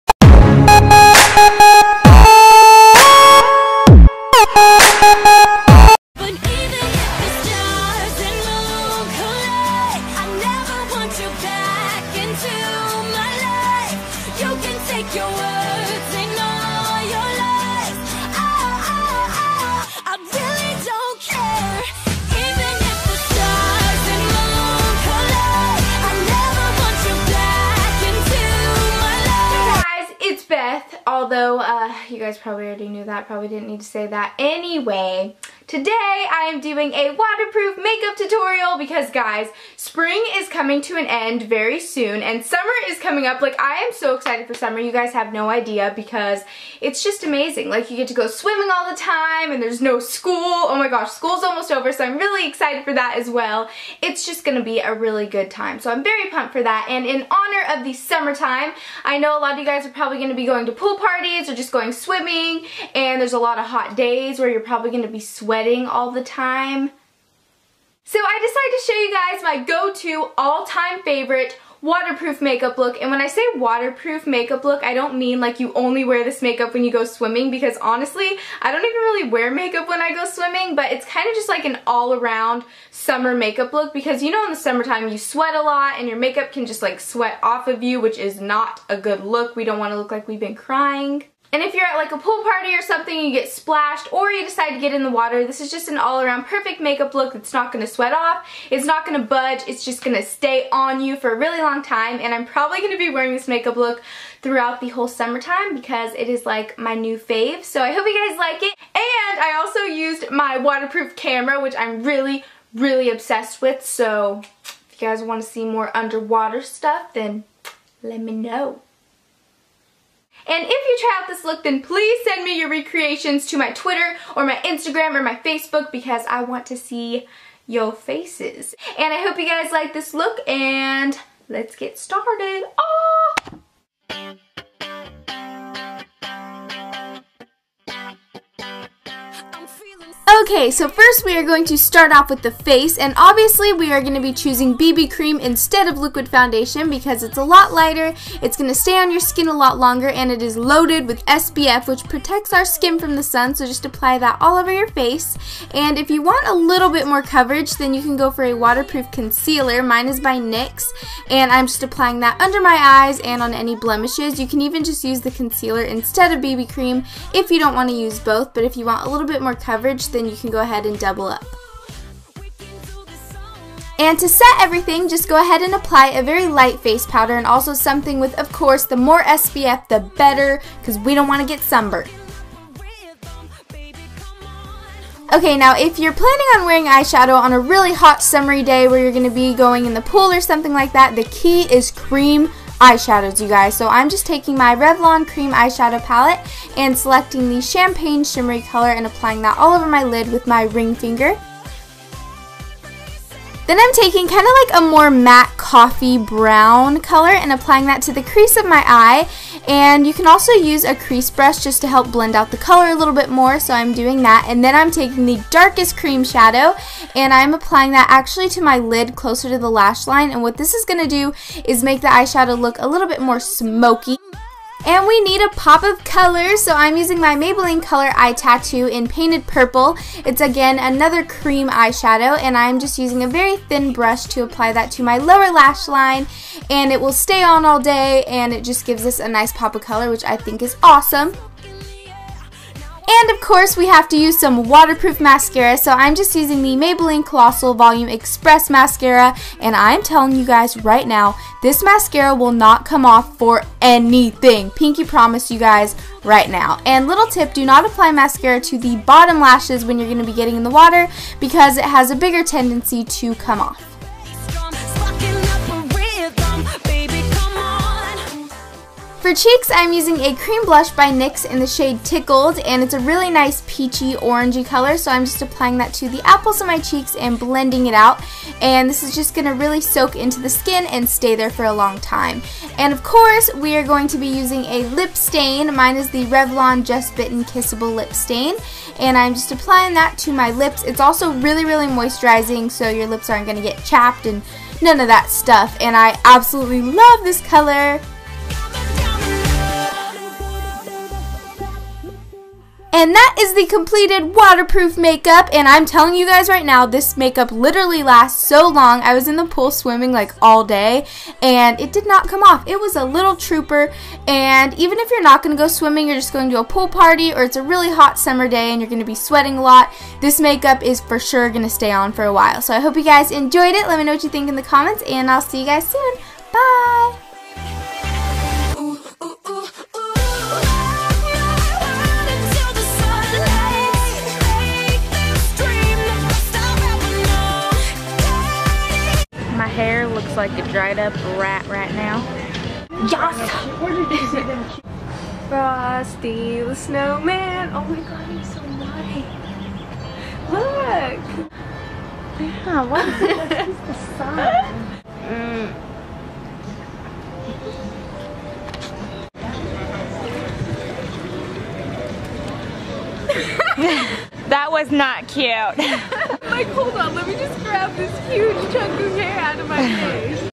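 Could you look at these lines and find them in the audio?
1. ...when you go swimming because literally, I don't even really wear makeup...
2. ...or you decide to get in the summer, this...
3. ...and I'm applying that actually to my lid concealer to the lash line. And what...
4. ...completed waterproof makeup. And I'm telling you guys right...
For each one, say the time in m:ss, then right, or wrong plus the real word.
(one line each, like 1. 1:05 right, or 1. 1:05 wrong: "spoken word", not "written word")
1. 1:16 wrong: "honestly", not "literally"
2. 1:34 wrong: "water", not "summer"
3. 3:37 wrong: "closer", not "concealer"
4. 5:03 right.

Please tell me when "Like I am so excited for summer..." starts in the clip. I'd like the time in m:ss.
0:43.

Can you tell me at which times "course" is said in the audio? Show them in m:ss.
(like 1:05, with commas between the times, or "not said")
2:58, 4:03, 4:43.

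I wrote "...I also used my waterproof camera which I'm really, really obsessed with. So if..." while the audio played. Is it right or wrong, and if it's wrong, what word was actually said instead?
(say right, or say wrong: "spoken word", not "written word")
right.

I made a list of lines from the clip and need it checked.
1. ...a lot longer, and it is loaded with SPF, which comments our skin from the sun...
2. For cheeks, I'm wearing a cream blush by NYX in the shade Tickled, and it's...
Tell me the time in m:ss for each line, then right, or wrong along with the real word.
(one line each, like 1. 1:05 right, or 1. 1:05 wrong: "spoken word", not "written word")
1. 2:29 wrong: "protects", not "comments"
2. 4:29 wrong: "using", not "wearing".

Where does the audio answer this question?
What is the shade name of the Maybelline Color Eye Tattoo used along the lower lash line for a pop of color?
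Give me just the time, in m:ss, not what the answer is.
3:49.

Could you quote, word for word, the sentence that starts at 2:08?
And I hope you guys like this look and let's get started.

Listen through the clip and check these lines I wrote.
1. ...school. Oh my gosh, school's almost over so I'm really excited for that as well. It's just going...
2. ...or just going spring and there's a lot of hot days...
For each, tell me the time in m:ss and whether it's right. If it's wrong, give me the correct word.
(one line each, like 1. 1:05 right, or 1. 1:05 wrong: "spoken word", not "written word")
1. 0:49 right
2. 1:01 wrong: "swimming", not "spring".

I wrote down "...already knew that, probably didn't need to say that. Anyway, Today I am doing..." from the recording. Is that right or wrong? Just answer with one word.
right.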